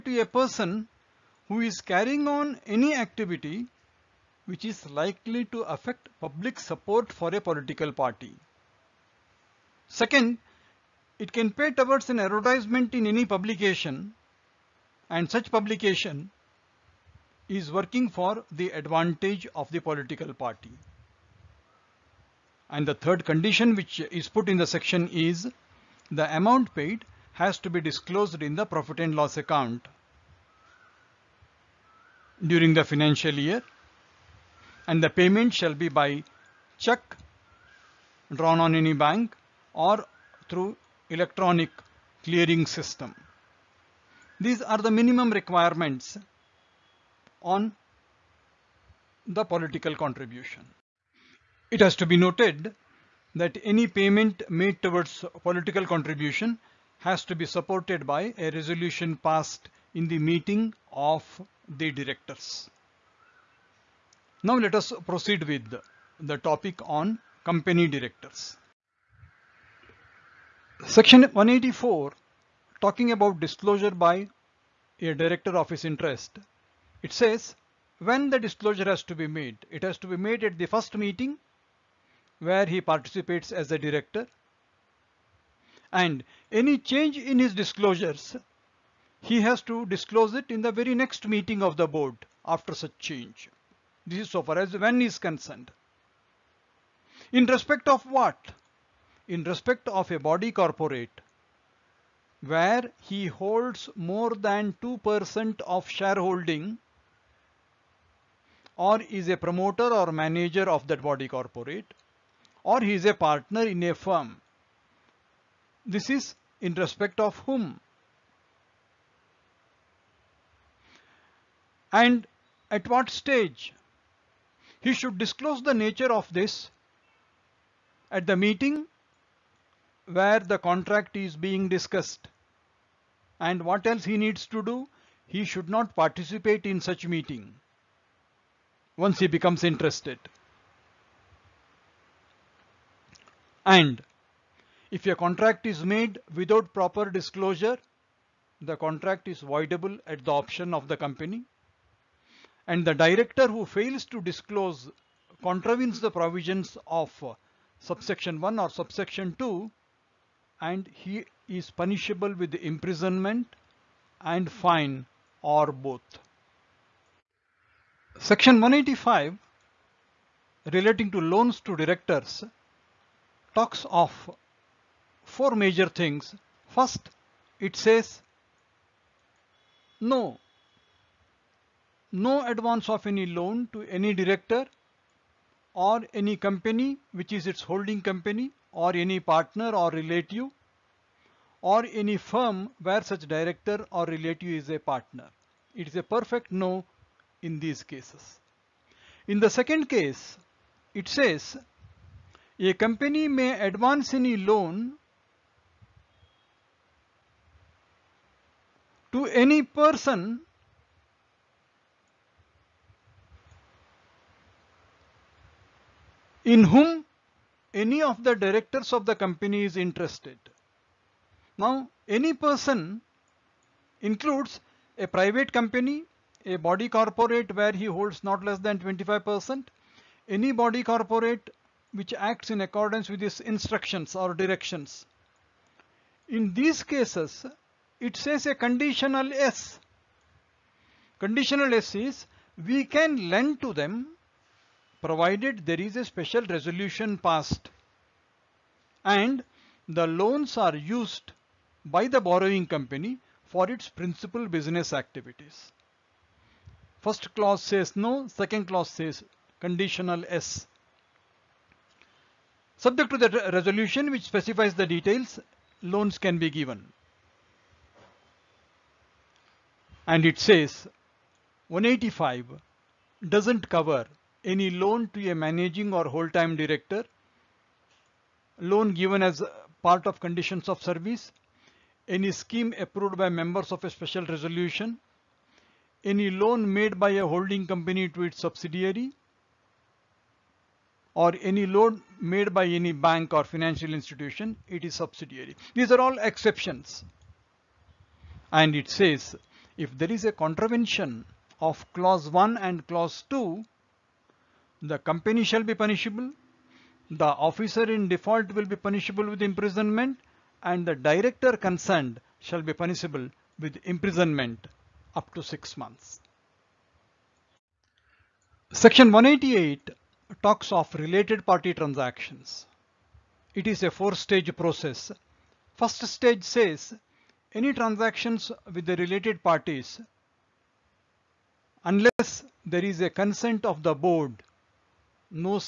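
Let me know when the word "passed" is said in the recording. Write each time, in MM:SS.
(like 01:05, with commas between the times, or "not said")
00:59, 04:07.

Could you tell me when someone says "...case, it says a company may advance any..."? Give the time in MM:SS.
03:19.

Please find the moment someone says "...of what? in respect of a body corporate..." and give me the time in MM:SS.
01:37.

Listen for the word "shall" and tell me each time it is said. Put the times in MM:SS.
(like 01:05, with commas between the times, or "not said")
00:35, 05:05, 05:12.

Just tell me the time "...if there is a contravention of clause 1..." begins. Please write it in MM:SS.
04:59.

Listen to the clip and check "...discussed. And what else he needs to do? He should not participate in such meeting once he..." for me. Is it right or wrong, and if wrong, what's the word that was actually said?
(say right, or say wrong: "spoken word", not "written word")
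right.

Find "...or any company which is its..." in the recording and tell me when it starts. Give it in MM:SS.
03:05.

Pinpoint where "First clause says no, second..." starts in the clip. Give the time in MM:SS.
04:16.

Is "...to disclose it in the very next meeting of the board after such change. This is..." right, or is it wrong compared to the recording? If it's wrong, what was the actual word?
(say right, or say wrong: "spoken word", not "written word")
right.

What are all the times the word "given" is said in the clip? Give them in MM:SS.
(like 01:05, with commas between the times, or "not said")
04:26, 04:38.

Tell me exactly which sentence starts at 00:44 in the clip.
These are the minimum requirements on the political contribution.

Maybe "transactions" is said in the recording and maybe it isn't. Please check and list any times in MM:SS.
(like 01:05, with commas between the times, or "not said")
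05:21, 05:27.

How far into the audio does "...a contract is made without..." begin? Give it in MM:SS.
02:25.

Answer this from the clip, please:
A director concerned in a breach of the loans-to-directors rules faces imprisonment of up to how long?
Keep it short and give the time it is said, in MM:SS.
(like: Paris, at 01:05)
six months, at 05:15.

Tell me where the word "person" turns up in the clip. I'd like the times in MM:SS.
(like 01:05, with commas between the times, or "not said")
00:00, 03:29, 03:42.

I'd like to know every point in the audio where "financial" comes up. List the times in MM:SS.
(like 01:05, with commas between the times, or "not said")
00:32, 04:53.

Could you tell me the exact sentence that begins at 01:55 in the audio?
This is in respect of whom?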